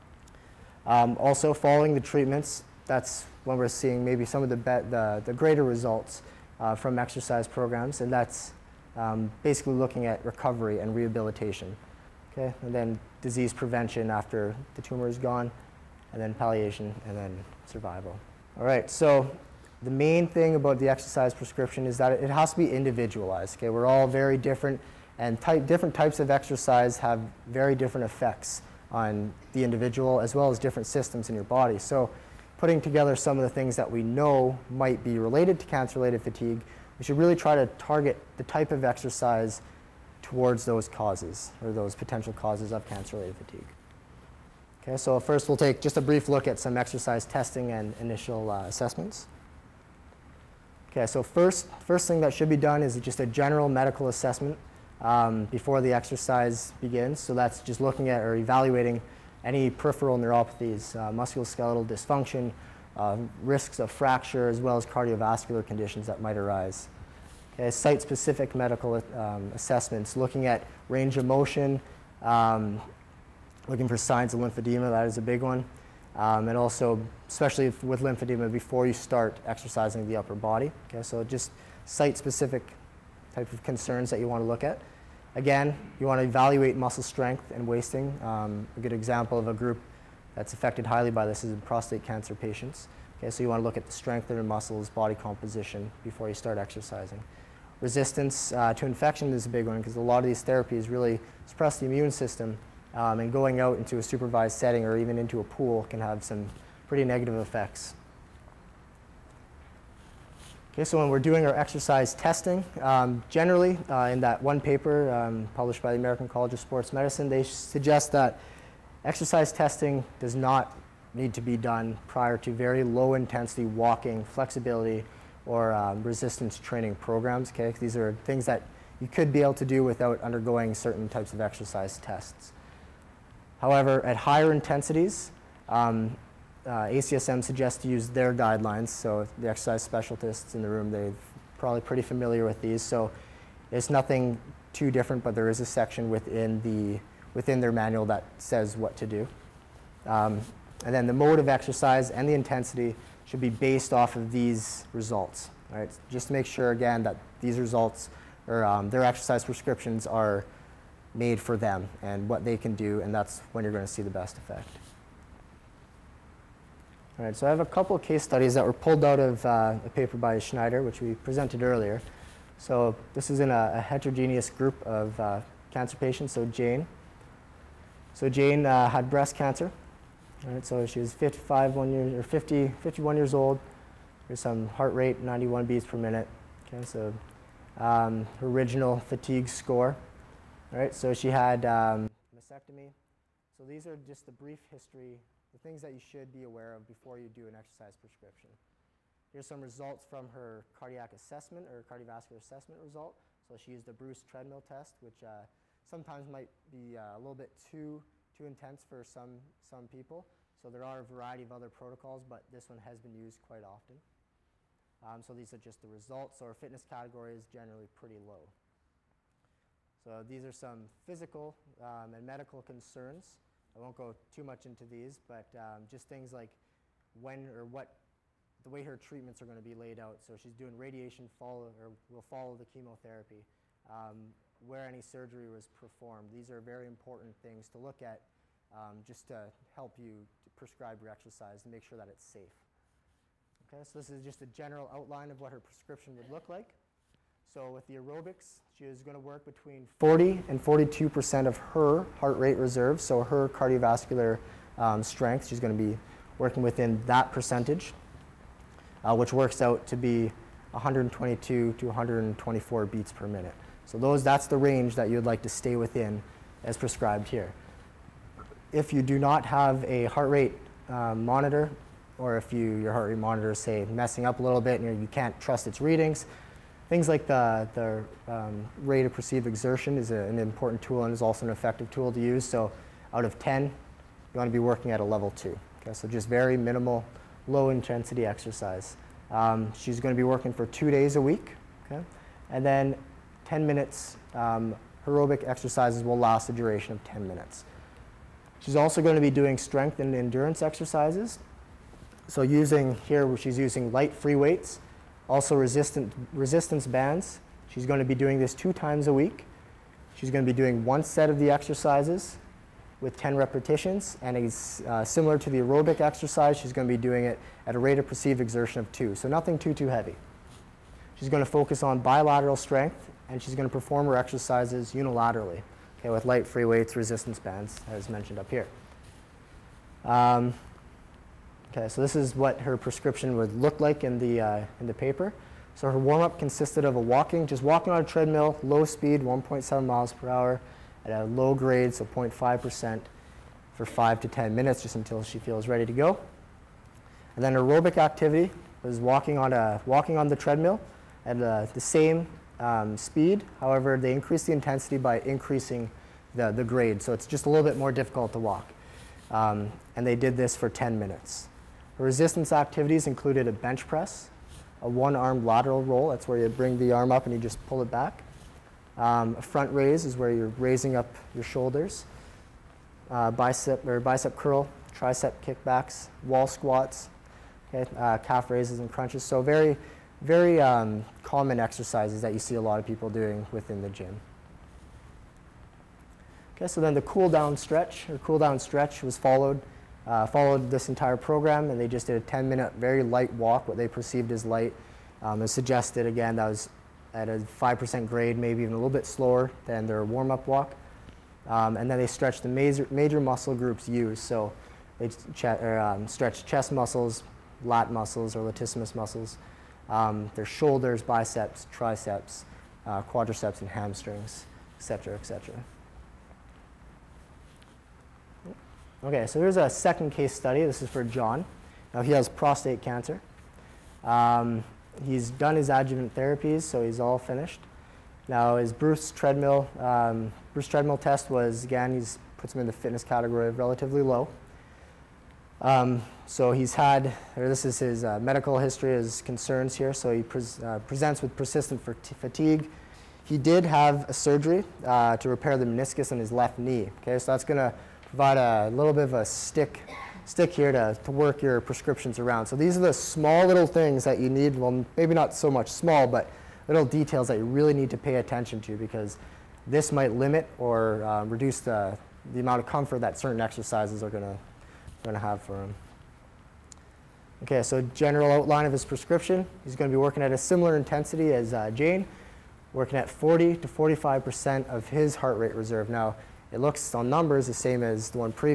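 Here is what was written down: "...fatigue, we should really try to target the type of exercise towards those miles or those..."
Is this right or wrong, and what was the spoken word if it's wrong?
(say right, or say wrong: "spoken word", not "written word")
wrong: "causes", not "miles".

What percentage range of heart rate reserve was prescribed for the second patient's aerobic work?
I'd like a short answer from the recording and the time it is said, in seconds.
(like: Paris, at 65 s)
40 to 45%, at 473 s.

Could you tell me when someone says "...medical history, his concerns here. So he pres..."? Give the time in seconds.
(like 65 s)
438 s.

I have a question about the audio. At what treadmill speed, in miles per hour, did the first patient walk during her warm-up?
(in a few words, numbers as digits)
1.7.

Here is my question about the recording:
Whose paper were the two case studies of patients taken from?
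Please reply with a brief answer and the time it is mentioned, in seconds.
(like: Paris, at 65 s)
Schneider, at 170 s.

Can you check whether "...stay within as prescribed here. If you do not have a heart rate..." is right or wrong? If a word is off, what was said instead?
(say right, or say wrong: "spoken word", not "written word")
right.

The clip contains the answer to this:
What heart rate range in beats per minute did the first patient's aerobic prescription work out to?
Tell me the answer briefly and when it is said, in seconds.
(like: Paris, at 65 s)
122 to 124, at 260 s.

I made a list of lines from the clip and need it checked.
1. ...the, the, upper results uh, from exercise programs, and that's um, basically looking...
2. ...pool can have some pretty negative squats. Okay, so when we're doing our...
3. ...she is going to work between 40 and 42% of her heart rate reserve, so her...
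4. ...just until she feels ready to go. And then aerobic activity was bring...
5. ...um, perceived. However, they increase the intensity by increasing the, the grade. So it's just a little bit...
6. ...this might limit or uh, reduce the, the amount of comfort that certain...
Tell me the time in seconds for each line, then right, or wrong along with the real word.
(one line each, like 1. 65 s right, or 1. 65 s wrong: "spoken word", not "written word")
1. 4 s wrong: "greater", not "upper"
2. 105 s wrong: "effects", not "squats"
3. 248 s right
4. 344 s wrong: "walking", not "bring"
5. 352 s wrong: "speed", not "perceived"
6. 459 s right.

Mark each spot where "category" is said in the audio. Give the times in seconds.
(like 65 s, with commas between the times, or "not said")
216 s, 433 s.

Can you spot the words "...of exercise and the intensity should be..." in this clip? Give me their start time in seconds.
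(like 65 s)
151 s.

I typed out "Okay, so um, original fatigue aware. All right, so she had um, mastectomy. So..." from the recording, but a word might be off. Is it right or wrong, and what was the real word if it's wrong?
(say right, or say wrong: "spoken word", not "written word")
wrong: "score", not "aware".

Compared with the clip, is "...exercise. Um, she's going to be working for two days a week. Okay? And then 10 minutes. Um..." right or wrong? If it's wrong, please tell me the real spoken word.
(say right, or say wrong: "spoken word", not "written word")
right.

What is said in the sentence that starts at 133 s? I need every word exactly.
However, at higher intensities, um, uh, ACSM suggests to use their guidelines.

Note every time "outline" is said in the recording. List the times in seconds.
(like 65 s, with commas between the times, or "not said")
244 s, 468 s.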